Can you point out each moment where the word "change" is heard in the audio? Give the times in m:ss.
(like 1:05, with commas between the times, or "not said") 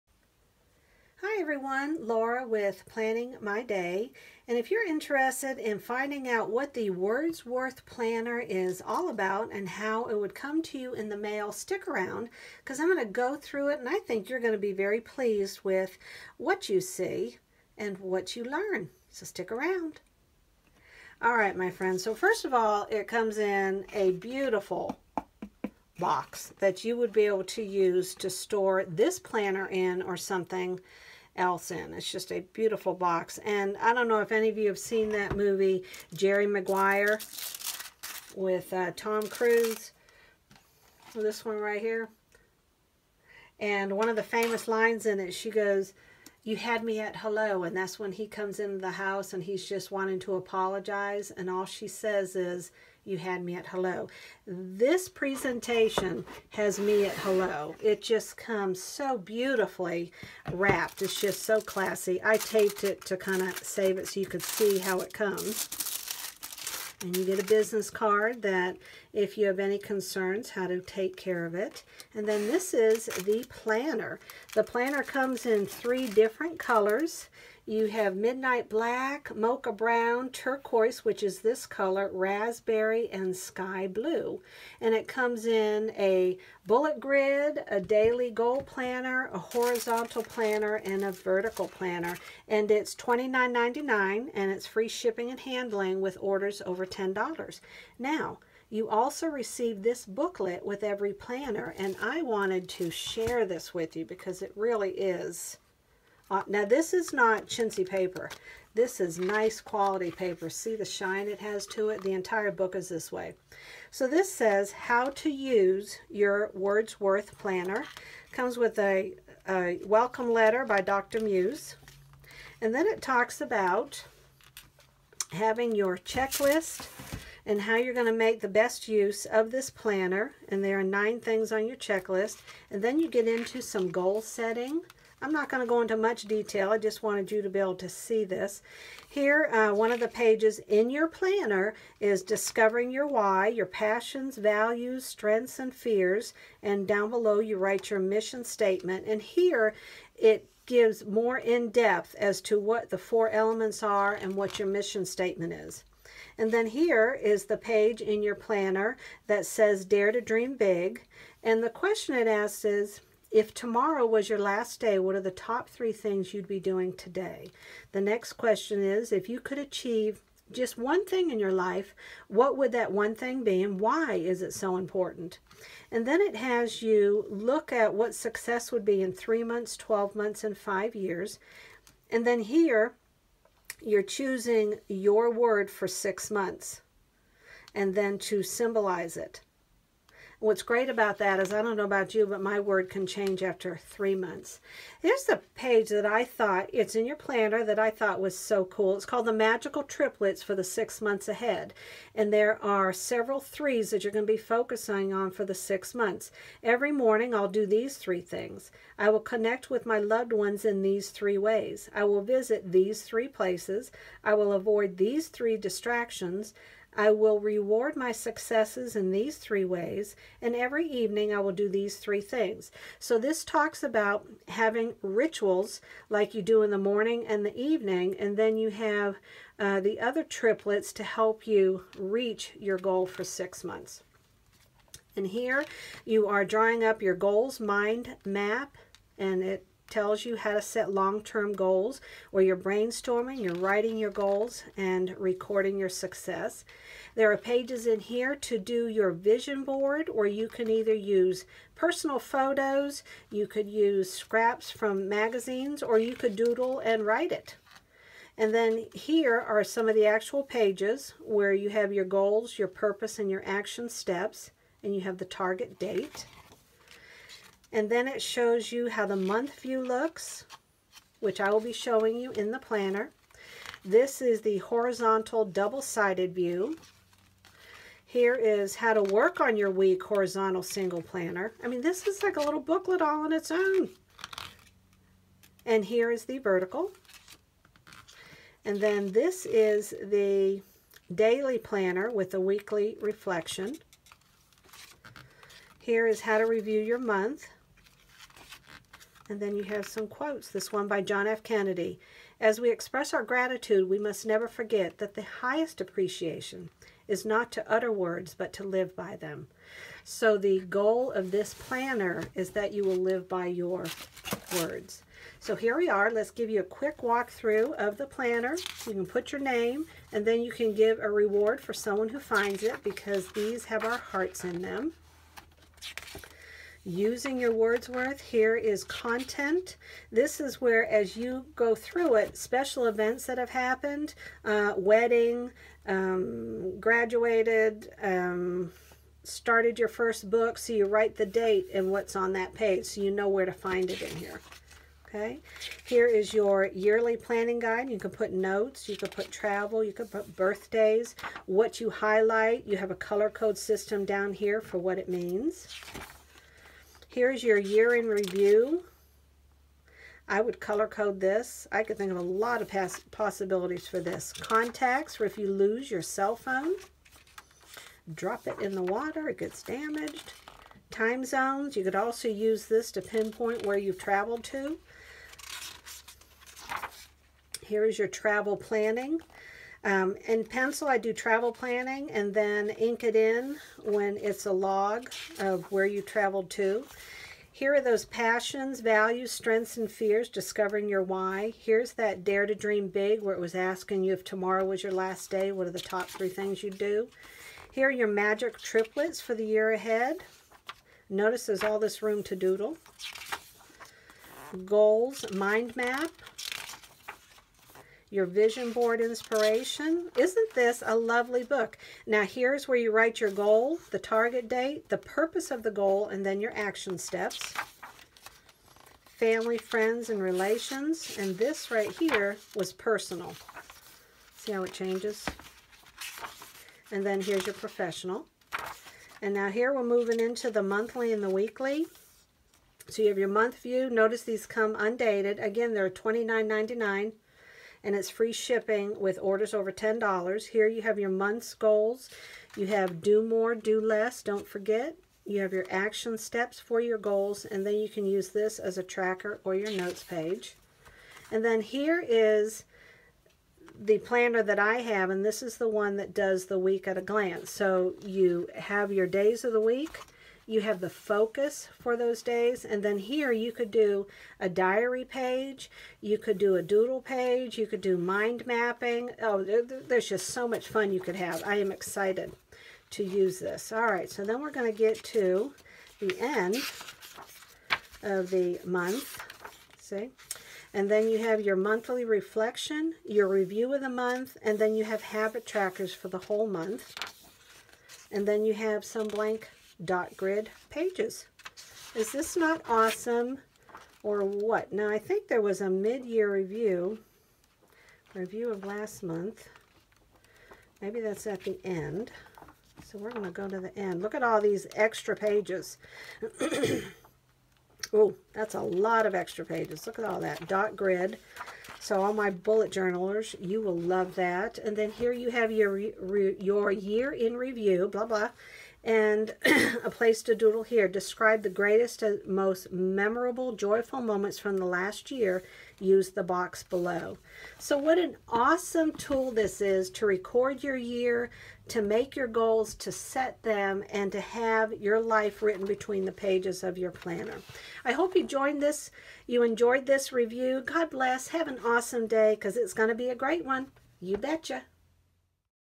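3:13, 7:04.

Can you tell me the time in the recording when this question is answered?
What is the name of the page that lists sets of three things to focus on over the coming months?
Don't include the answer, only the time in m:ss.
3:19.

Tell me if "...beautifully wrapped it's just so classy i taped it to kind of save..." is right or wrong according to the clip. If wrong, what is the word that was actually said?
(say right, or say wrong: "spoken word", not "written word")
right.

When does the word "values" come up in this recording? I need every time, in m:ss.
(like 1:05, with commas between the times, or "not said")
2:24, 6:28.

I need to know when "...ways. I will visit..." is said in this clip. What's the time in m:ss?
3:31.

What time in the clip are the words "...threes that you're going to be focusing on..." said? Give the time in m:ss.
3:23.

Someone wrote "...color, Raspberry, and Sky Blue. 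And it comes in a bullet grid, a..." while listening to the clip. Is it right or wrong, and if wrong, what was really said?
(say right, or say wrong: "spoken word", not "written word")
right.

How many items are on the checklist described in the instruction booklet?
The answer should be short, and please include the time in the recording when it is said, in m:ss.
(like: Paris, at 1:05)
9, at 2:10.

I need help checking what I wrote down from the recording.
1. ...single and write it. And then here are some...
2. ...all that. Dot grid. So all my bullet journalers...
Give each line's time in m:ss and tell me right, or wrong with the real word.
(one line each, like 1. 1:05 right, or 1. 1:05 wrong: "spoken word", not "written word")
1. 4:16 wrong: "doodle", not "single"
2. 8:30 right.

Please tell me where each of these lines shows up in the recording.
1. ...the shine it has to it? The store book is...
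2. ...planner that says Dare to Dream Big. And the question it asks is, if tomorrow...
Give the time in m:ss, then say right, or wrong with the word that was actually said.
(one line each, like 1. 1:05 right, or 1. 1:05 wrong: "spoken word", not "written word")
1. 1:50 wrong: "entire", not "store"
2. 2:38 right.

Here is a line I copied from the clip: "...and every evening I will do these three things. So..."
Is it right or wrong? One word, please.
right.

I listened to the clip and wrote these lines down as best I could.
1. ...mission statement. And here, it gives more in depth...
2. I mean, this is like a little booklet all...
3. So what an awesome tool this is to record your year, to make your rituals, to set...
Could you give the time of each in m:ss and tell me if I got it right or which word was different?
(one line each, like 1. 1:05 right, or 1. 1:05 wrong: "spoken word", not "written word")
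1. 2:27 right
2. 4:41 right
3. 8:47 wrong: "goals", not "rituals".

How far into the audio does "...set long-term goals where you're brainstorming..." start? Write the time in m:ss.
4:00.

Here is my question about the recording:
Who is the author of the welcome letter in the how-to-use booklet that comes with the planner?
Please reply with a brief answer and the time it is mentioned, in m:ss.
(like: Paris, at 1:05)
Dr. Muse, at 2:00.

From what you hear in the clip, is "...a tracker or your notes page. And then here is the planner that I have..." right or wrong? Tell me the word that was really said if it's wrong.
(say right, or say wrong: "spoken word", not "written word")
right.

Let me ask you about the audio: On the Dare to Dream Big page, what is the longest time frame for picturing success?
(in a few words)
5 years.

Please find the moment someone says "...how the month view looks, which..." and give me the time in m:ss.
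4:28.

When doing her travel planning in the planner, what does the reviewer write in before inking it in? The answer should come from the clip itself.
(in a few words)
pencil.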